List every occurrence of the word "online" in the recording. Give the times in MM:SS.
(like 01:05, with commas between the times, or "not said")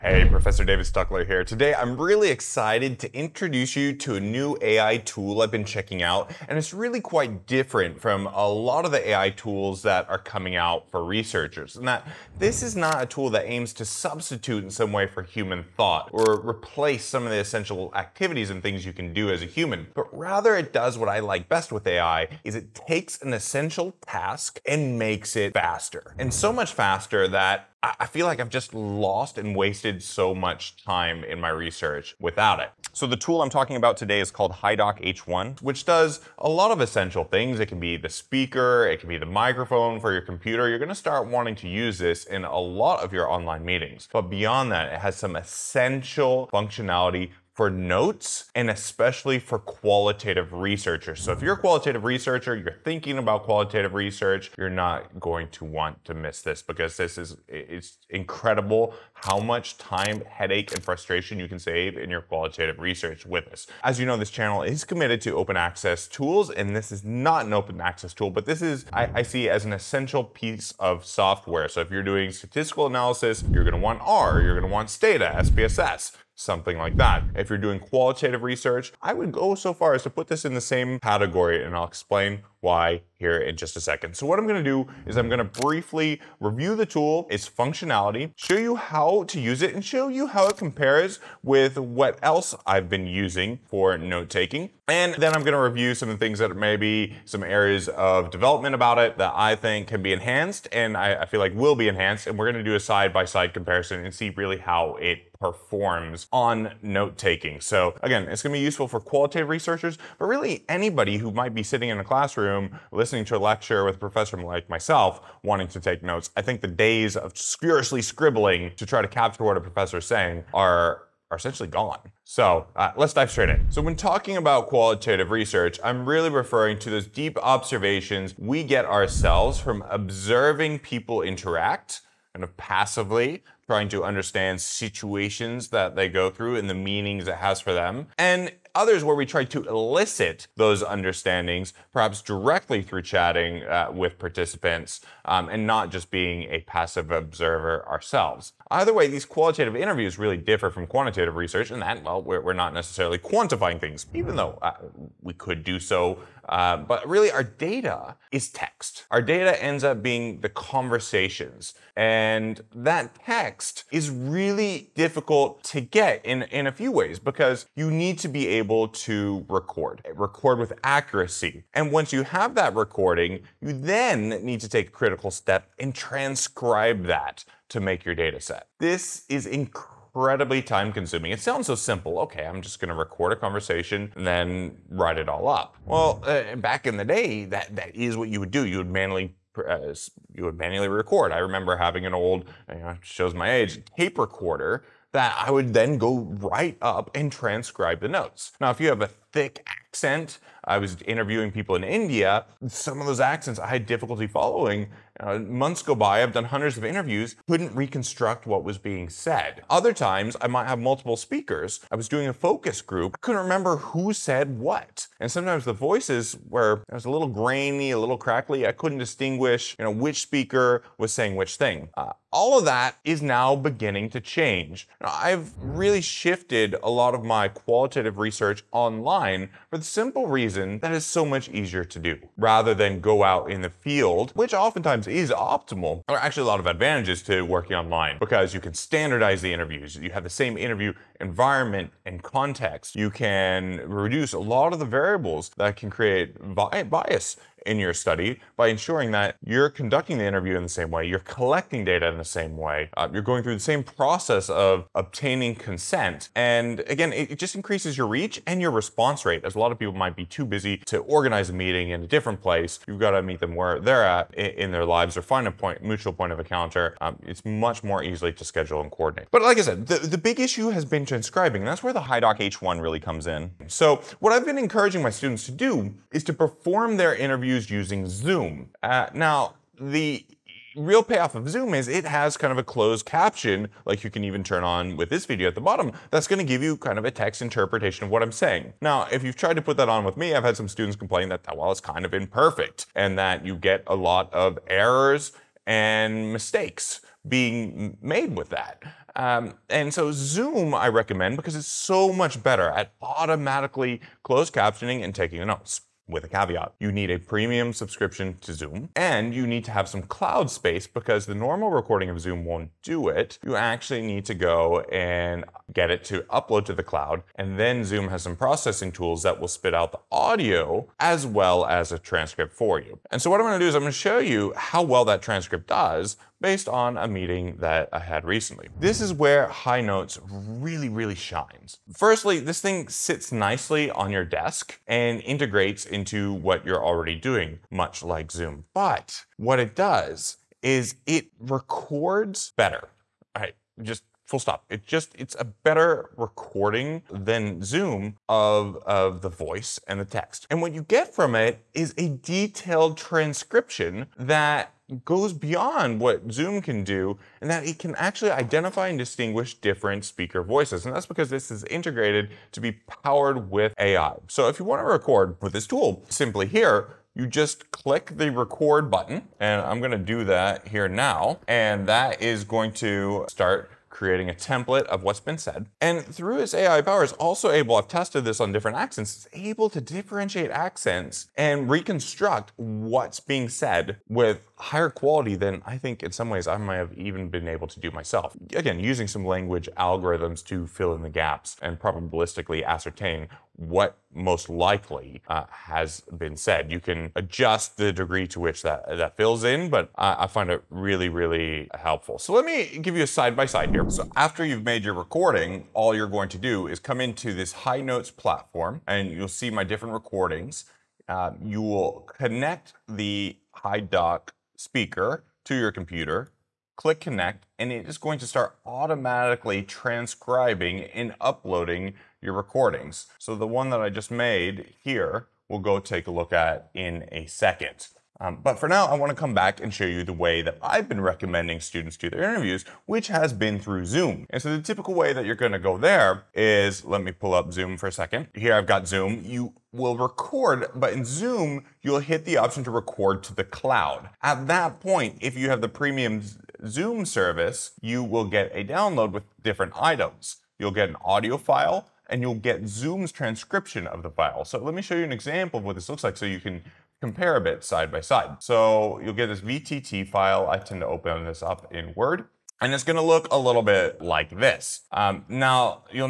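00:43, 03:48, 03:57.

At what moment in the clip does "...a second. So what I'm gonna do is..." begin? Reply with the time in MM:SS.
01:23.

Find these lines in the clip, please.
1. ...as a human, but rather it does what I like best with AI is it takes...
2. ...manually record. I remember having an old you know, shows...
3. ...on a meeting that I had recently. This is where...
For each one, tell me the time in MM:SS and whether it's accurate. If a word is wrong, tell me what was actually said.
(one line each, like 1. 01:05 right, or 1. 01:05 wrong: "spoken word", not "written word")
1. 00:19 right
2. 03:10 right
3. 05:26 right.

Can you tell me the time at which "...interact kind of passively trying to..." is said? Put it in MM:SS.
02:11.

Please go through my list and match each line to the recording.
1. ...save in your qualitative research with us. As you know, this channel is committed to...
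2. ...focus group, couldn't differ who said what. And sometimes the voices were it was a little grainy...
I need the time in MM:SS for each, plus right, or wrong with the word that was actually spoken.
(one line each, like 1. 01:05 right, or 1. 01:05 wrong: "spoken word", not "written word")
1. 01:01 right
2. 03:32 wrong: "remember", not "differ".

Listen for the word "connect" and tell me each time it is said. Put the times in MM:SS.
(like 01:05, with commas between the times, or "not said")
06:52, 06:57.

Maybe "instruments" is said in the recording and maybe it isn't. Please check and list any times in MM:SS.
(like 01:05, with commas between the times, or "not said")
not said.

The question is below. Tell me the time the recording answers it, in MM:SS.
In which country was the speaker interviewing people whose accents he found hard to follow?
03:21.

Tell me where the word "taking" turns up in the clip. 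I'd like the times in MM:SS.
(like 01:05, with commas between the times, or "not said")
01:33, 01:47, 05:05.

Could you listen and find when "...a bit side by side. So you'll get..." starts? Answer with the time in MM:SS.
07:37.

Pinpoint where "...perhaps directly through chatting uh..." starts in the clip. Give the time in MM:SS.
02:21.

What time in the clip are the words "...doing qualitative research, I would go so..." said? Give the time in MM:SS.
01:17.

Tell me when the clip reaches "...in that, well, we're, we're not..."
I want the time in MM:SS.
02:31.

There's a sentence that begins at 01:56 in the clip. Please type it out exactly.
I think the days of furiously scribbling to try to capture what a professor is saying are are essentially gone.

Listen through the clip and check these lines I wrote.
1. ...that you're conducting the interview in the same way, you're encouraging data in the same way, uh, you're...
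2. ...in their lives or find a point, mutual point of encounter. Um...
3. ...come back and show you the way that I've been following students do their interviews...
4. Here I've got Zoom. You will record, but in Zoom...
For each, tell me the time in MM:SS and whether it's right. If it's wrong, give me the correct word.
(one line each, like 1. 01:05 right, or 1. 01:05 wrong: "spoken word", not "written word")
1. 04:09 wrong: "collecting", not "encouraging"
2. 04:24 right
3. 07:09 wrong: "recommending", not "following"
4. 07:18 right.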